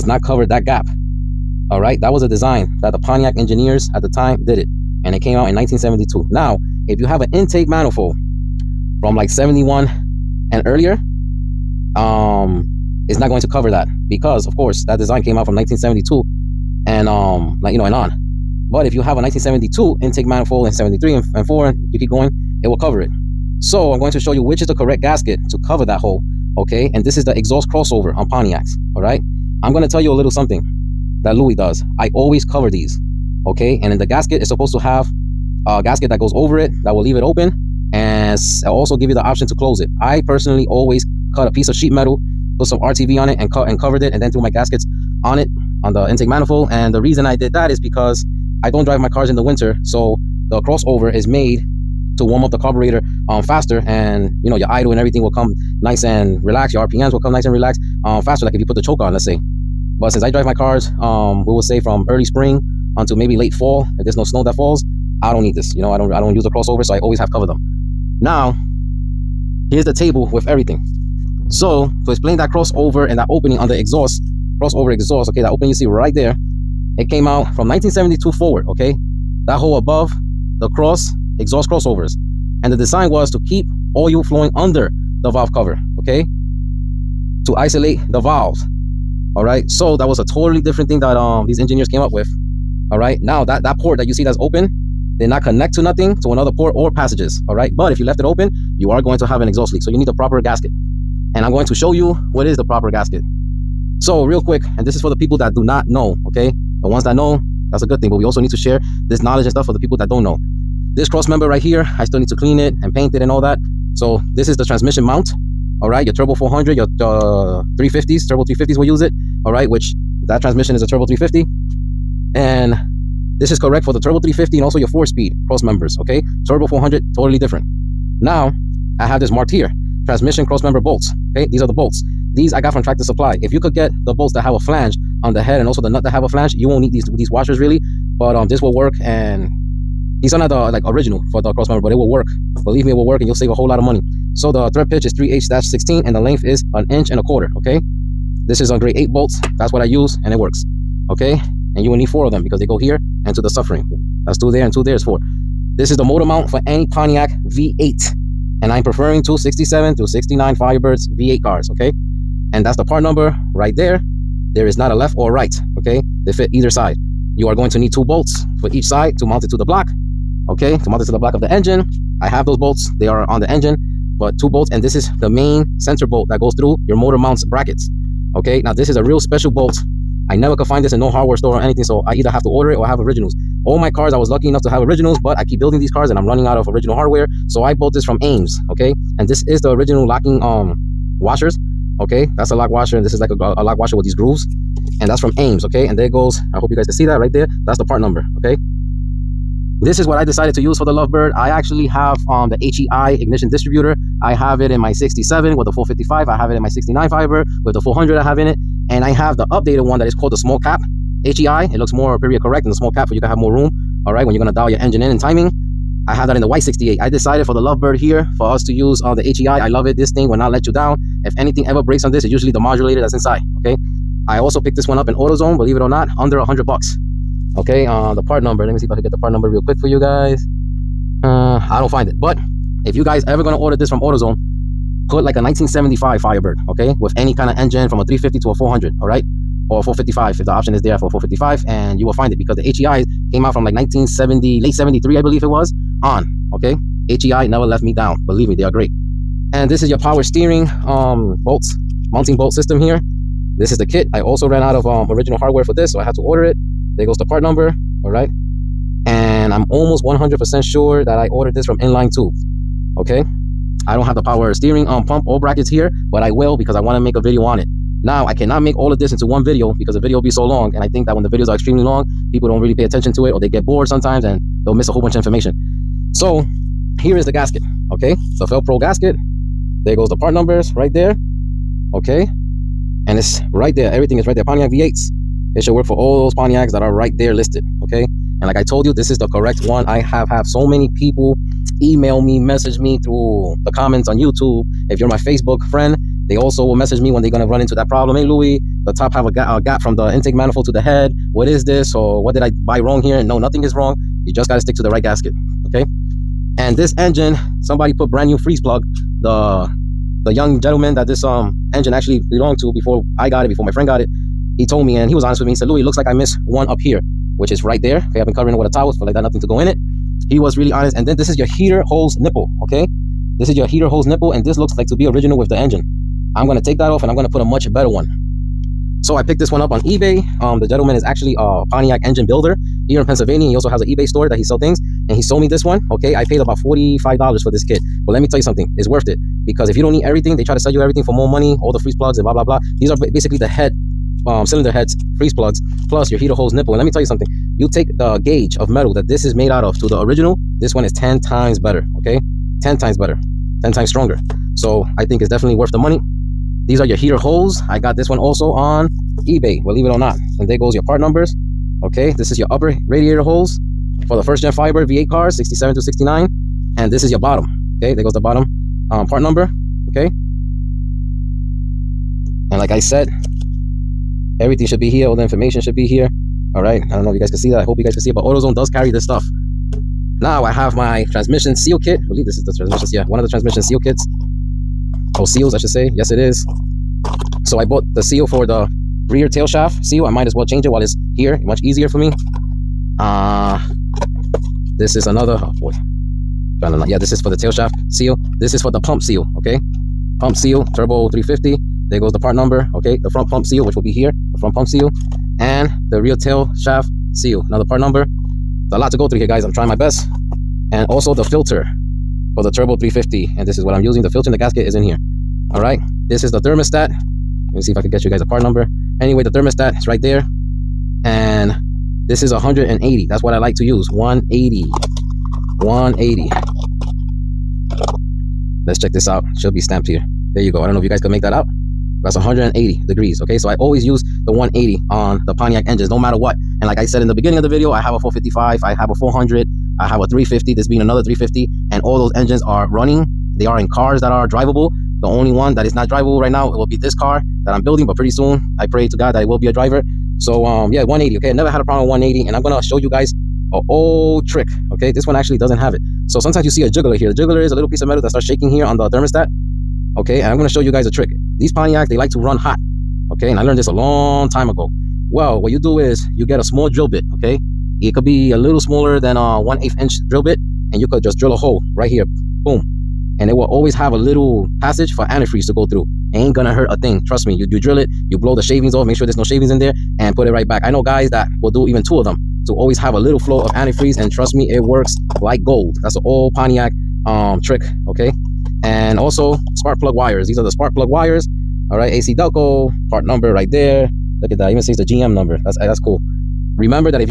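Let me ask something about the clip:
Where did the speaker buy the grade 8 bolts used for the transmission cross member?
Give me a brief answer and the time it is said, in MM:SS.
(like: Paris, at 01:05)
Tractor Supply, at 02:12.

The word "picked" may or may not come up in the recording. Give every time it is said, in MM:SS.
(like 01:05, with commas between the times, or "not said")
03:44, 05:29.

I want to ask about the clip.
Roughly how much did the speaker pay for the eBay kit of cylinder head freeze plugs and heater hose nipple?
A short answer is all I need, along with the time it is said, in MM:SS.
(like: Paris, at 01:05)
$45, at 05:36.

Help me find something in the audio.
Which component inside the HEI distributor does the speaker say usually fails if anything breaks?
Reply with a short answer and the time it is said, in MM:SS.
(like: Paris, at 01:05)
The modulator, at 03:42.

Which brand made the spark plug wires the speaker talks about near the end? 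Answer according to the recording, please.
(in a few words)
AC Delco.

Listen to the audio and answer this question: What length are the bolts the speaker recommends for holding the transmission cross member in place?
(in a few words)
1 1/4 inch.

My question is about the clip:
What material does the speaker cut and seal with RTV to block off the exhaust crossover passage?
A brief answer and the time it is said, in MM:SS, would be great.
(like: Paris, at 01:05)
Sheet metal, at 00:41.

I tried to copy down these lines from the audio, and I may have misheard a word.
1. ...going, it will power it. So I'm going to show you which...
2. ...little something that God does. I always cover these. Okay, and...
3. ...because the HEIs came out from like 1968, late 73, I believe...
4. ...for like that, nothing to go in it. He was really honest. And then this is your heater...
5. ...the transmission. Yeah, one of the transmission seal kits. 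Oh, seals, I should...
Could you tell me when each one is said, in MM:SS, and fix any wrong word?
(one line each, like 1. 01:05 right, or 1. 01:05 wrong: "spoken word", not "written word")
1. 00:22 wrong: "cover", not "power"
2. 00:30 wrong: "Louis", not "God"
3. 04:02 wrong: "1970", not "1968"
4. 05:18 right
5. 06:22 right.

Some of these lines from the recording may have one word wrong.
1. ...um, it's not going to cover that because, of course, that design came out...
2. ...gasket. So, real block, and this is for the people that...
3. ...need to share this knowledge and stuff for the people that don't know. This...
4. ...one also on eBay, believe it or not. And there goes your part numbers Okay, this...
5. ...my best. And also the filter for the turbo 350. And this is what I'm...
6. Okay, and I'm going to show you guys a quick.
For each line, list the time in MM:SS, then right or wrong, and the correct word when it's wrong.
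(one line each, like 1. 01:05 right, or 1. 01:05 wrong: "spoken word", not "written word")
1. 00:11 right
2. 01:42 wrong: "quick", not "block"
3. 01:48 right
4. 05:58 right
5. 06:49 right
6. 07:39 wrong: "trick", not "quick".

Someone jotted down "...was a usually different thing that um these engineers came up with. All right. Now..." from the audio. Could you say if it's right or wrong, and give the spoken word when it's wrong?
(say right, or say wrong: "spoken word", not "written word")
wrong: "totally", not "usually".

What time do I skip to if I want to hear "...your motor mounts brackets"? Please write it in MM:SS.
02:56.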